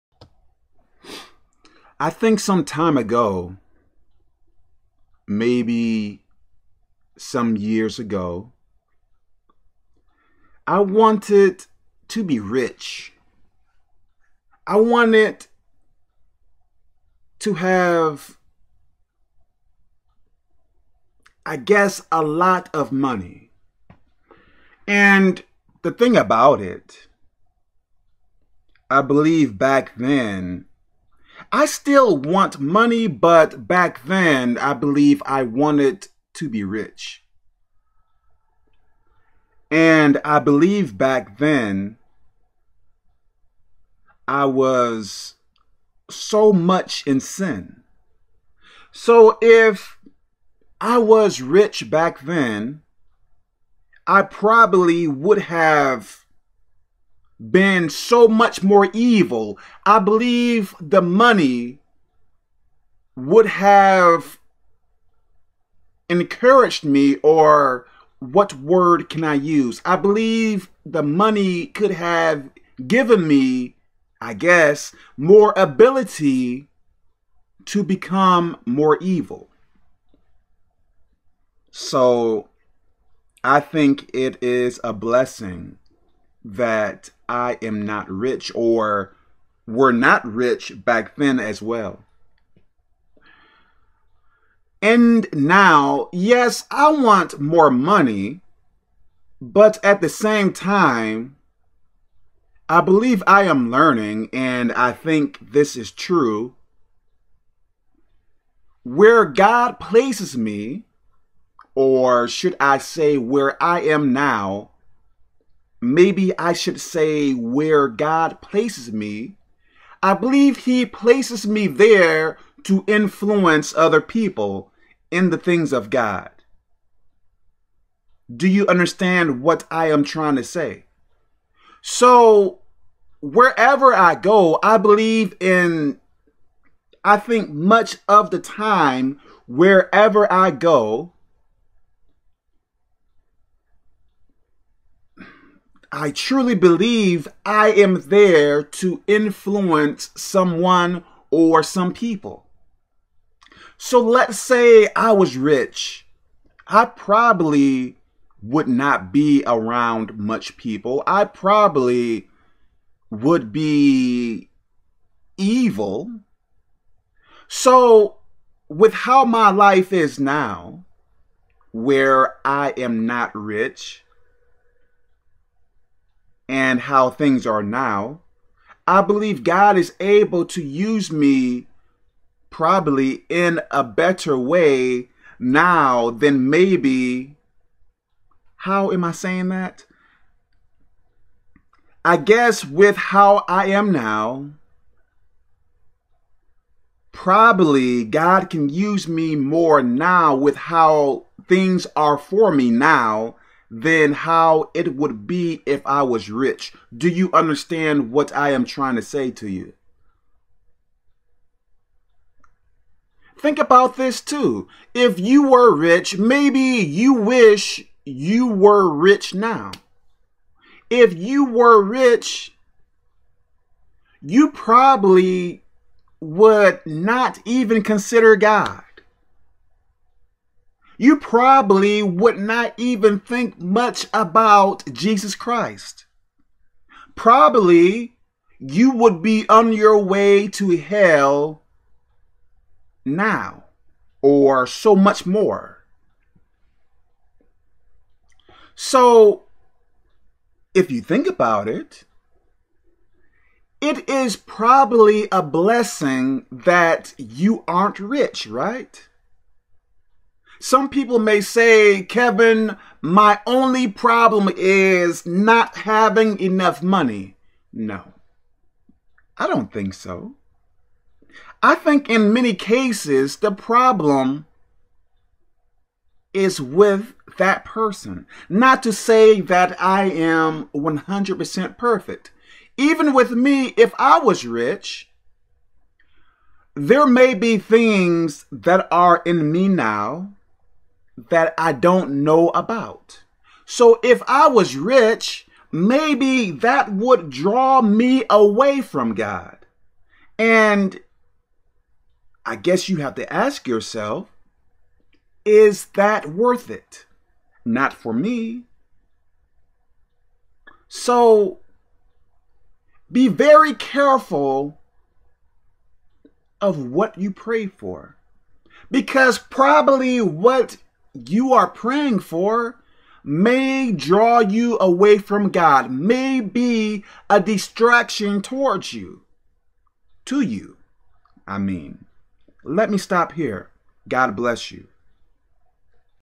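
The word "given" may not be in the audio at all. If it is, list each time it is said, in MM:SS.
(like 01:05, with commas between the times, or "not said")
01:12.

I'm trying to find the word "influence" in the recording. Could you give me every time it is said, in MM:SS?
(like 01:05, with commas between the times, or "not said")
02:02, 02:29.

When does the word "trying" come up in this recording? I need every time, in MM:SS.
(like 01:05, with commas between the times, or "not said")
02:10, 03:28.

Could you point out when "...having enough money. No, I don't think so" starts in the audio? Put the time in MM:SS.
04:25.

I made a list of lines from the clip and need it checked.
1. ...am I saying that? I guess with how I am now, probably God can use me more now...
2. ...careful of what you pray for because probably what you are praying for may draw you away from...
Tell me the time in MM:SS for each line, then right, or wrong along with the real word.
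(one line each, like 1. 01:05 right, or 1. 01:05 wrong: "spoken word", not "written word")
1. 03:08 right
2. 05:13 right.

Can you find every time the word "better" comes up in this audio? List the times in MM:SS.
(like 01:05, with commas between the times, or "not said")
03:03.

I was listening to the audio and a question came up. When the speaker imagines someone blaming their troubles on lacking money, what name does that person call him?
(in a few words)
Kevin.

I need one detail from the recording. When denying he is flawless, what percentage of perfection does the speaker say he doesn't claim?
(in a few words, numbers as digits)
100%.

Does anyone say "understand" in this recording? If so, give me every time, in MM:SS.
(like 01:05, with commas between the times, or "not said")
02:08, 03:27.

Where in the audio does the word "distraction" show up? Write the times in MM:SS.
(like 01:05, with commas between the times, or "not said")
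05:27.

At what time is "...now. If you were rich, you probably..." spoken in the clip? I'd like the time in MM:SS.
03:39.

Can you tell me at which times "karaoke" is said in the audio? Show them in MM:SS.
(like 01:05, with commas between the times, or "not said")
not said.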